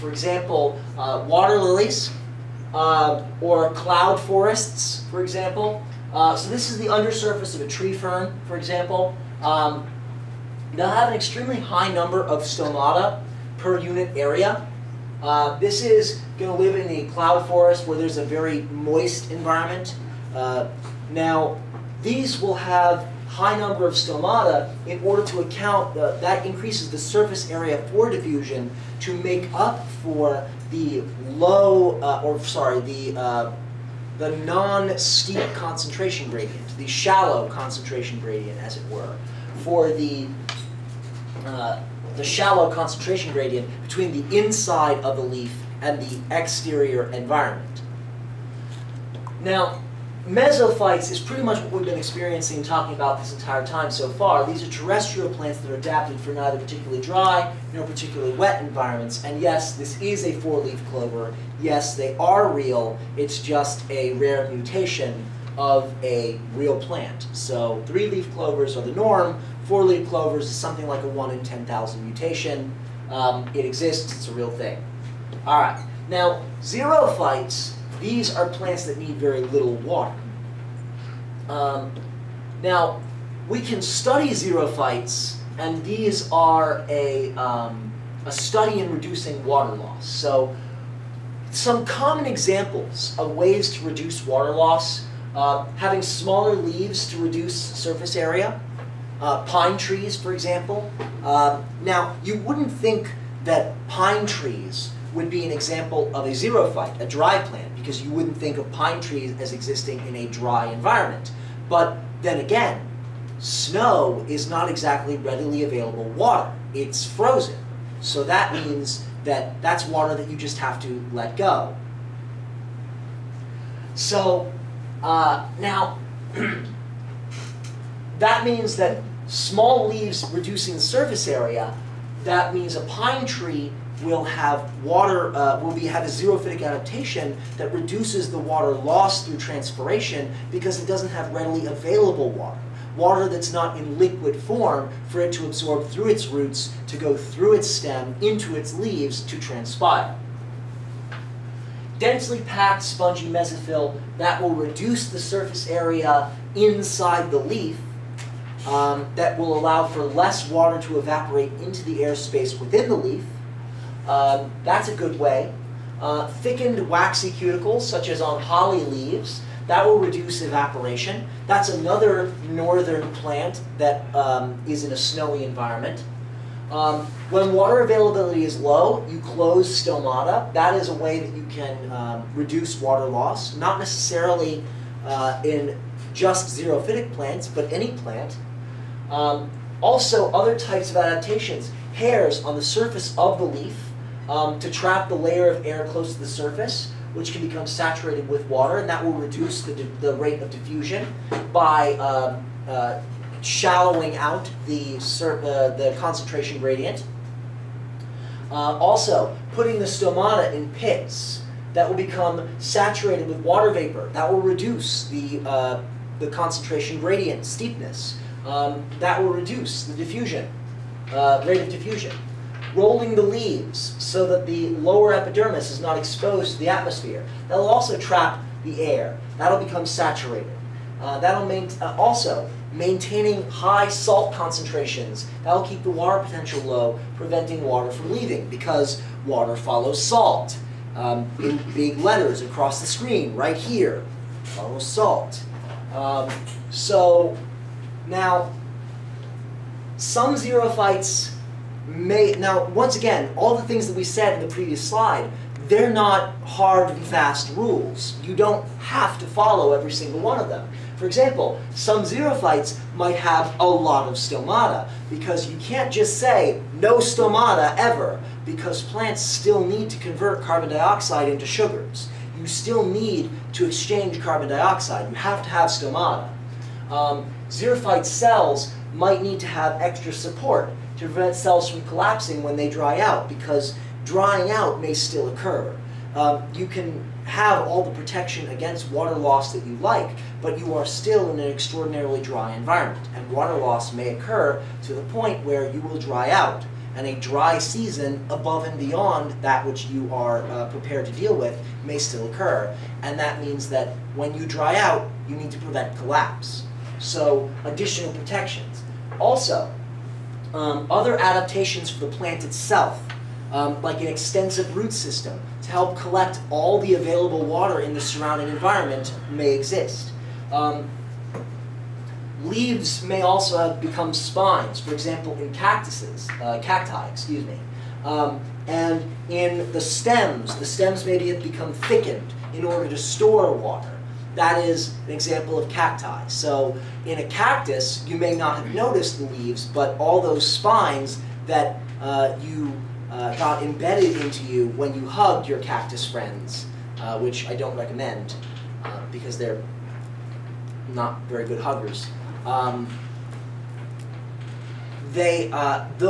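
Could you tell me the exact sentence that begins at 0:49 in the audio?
Now, Mesophytes is pretty much what we've been experiencing and talking about this entire time so far.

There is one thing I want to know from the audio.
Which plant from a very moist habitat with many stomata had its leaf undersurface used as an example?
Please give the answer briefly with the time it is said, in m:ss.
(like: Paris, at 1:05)
Tree fern, at 0:07.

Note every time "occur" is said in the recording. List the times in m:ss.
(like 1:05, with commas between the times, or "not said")
4:45, 4:54, 5:02.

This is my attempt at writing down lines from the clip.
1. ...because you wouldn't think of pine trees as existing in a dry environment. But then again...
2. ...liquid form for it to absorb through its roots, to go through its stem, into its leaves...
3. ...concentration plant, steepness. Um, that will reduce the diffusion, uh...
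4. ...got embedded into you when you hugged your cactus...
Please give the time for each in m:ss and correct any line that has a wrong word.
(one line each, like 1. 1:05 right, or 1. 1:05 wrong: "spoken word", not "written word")
1. 1:47 right
2. 2:23 right
3. 3:36 wrong: "gradient", not "plant"
4. 5:43 right.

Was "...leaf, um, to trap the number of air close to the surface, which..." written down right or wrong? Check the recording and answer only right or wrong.
wrong.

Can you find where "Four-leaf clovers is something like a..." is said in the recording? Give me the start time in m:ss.
1:09.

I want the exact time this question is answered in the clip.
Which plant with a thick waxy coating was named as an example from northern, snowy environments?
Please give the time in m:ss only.
2:48.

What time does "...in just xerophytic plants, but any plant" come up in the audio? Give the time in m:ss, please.
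3:05.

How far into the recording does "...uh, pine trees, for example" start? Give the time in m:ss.
1:39.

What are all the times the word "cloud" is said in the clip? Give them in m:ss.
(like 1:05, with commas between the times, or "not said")
0:03, 0:17.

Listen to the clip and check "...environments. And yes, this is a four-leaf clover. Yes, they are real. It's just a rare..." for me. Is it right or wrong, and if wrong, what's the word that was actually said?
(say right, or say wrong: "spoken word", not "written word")
right.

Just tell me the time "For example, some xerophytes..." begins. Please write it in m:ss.
4:20.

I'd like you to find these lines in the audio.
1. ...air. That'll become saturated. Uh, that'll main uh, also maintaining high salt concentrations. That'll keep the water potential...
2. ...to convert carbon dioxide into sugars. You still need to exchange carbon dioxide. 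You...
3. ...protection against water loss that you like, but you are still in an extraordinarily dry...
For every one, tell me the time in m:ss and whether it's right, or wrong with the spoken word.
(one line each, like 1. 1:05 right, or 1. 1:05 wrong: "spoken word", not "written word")
1. 3:48 right
2. 4:29 right
3. 4:47 right.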